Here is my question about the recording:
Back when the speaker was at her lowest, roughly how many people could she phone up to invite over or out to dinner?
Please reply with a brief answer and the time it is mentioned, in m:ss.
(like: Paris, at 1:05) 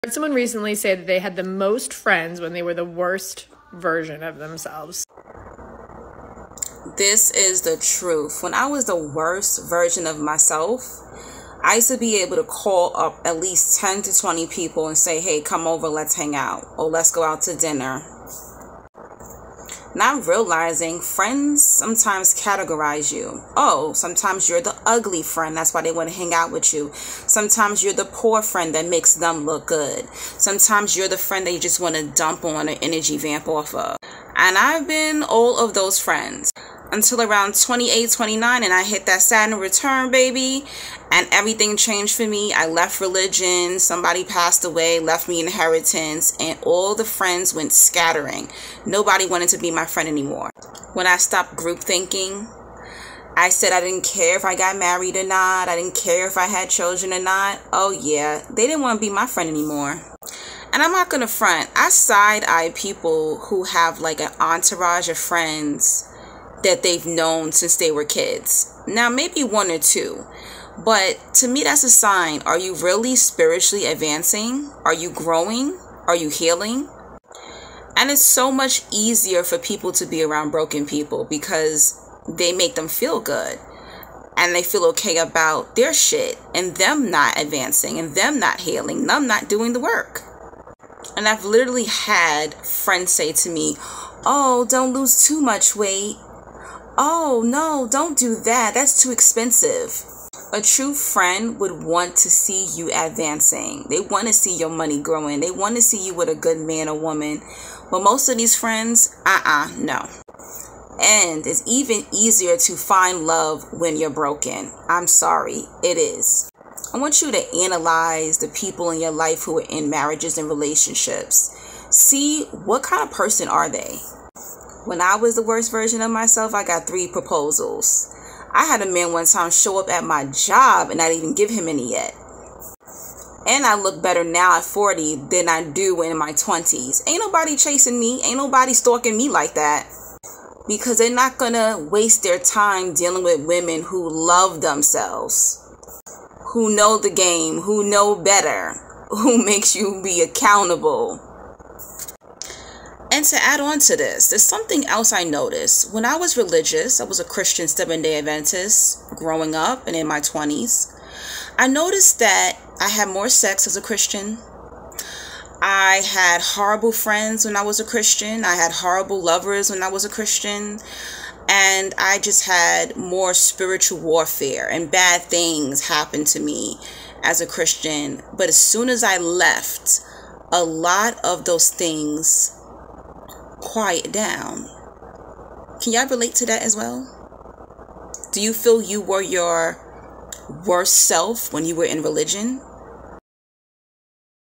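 10 to 20, at 0:13.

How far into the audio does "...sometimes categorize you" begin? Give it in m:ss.
0:21.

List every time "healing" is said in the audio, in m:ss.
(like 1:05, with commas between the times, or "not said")
1:16, 1:28.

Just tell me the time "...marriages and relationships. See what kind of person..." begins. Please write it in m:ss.
1:59.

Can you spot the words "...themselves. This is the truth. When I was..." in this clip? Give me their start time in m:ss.
0:04.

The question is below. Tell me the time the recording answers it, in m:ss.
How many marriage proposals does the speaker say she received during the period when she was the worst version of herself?
2:06.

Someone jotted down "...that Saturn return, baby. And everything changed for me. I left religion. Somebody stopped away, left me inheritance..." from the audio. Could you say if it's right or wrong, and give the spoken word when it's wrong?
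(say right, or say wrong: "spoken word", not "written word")
wrong: "passed", not "stopped".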